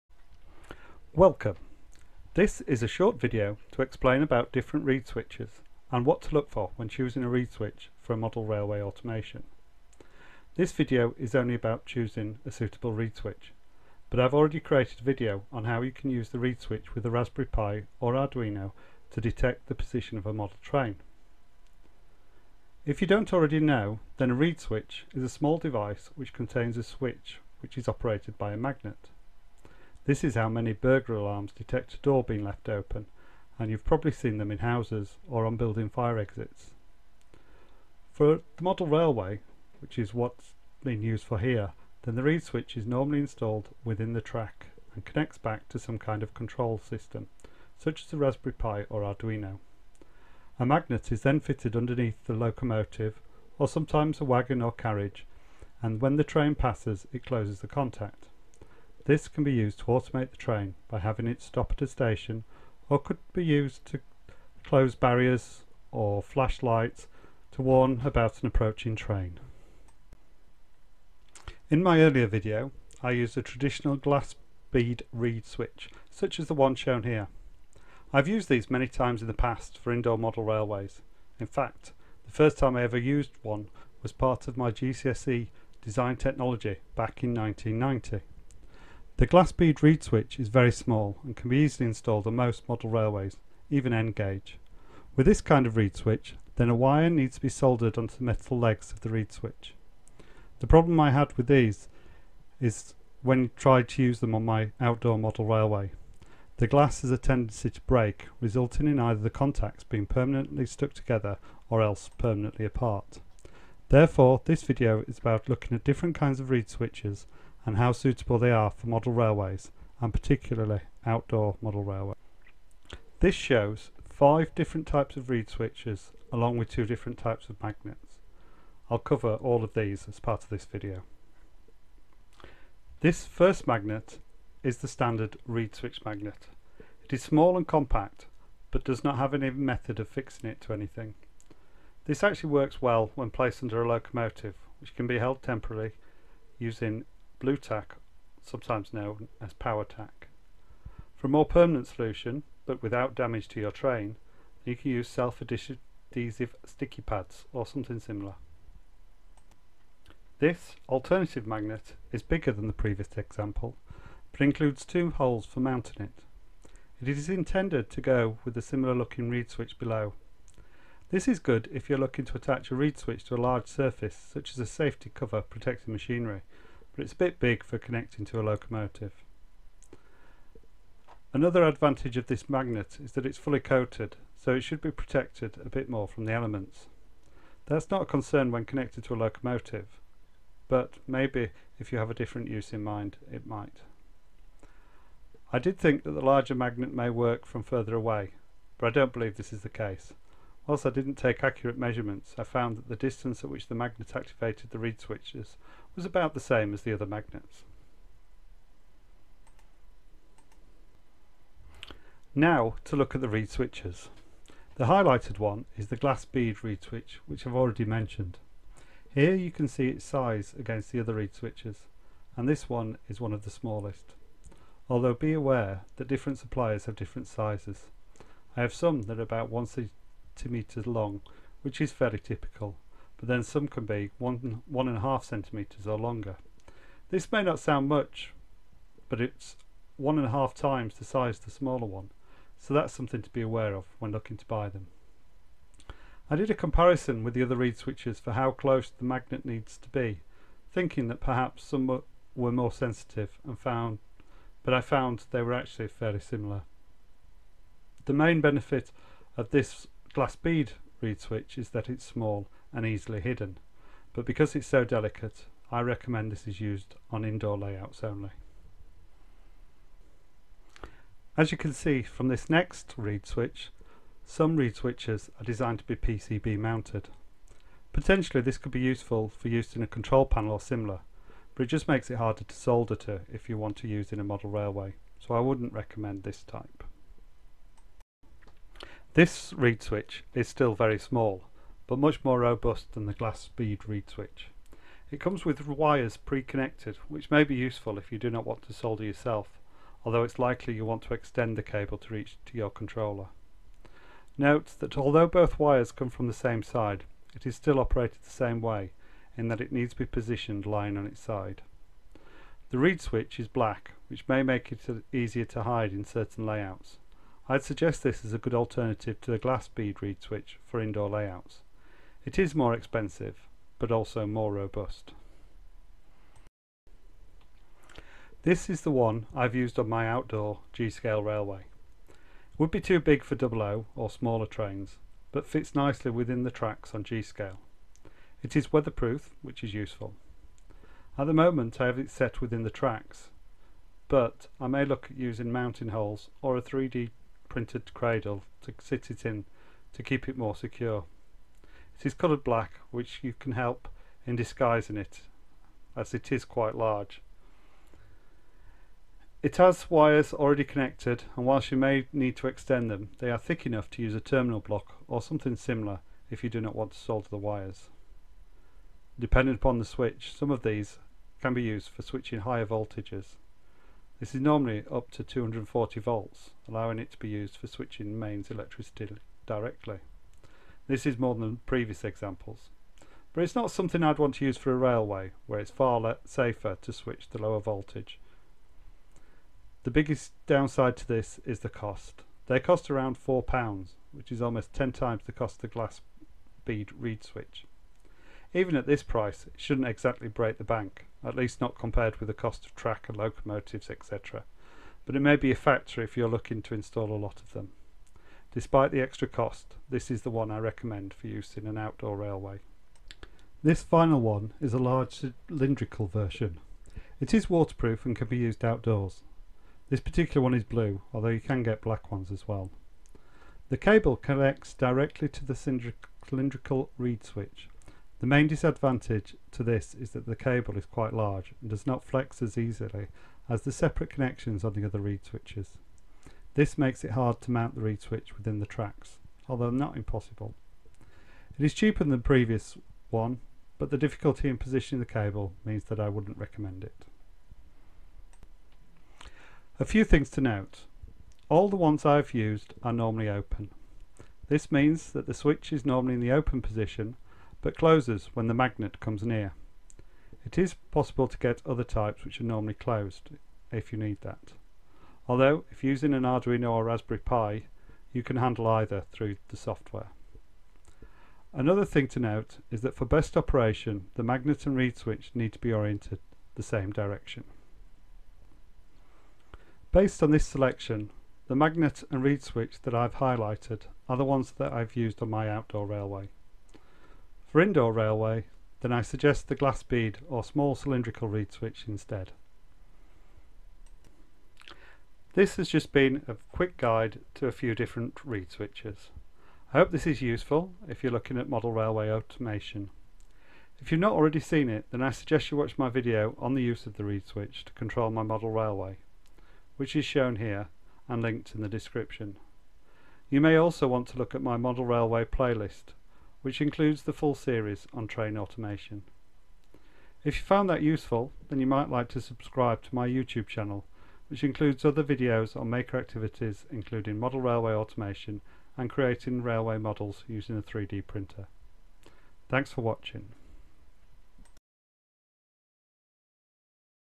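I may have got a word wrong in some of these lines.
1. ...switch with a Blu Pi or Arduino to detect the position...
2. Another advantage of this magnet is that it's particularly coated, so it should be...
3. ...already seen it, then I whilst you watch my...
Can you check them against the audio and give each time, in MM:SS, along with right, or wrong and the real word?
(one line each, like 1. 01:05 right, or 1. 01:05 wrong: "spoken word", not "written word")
1. 00:16 wrong: "Raspberry", not "Blu"
2. 03:01 wrong: "fully", not "particularly"
3. 08:24 wrong: "suggest", not "whilst".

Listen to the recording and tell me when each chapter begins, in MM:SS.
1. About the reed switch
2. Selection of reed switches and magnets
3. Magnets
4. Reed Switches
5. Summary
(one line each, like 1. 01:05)
1. 01:11
2. 02:02
3. 02:17
4. 03:35
5. 07:31.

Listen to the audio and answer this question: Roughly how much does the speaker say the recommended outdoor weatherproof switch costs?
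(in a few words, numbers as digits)
£4.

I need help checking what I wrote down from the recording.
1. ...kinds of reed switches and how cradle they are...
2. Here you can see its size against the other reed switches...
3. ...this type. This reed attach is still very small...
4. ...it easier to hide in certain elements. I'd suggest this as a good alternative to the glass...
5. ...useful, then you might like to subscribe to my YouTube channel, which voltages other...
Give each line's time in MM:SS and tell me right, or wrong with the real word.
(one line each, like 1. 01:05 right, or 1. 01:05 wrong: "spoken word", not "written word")
1. 01:56 wrong: "suitable", not "cradle"
2. 03:39 right
3. 04:46 wrong: "switch", not "attach"
4. 05:14 wrong: "layouts", not "elements"
5. 08:40 wrong: "includes", not "voltages".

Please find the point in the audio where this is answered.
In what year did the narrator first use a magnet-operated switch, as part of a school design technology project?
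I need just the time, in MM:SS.
01:27.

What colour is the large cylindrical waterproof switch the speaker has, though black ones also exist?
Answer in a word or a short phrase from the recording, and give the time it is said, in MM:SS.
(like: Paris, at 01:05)
blue, at 07:00.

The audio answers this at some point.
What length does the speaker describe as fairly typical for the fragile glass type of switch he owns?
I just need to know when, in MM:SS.
03:49.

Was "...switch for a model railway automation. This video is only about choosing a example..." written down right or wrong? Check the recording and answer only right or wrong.
wrong.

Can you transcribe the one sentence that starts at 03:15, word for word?
I did think that the larger magnet may work from further away, but I don't believe this is the case.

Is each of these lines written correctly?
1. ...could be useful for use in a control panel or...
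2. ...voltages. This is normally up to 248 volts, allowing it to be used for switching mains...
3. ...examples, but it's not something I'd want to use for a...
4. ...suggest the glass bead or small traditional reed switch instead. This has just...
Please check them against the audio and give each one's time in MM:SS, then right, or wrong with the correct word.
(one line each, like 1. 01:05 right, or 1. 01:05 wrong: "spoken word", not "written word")
1. 04:38 right
2. 06:12 wrong: "240", not "248"
3. 06:22 right
4. 08:09 wrong: "cylindrical", not "traditional".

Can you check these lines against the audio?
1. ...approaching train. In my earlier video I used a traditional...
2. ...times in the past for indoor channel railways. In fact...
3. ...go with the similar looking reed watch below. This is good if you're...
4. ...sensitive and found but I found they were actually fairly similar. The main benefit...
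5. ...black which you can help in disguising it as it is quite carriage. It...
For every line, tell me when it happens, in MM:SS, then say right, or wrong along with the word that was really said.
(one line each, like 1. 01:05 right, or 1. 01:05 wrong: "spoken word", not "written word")
1. 01:08 right
2. 01:18 wrong: "model", not "channel"
3. 02:48 wrong: "switch", not "watch"
4. 04:12 right
5. 05:52 wrong: "large", not "carriage".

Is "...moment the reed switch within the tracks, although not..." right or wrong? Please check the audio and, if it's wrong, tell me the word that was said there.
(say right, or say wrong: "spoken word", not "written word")
wrong: "mount", not "moment".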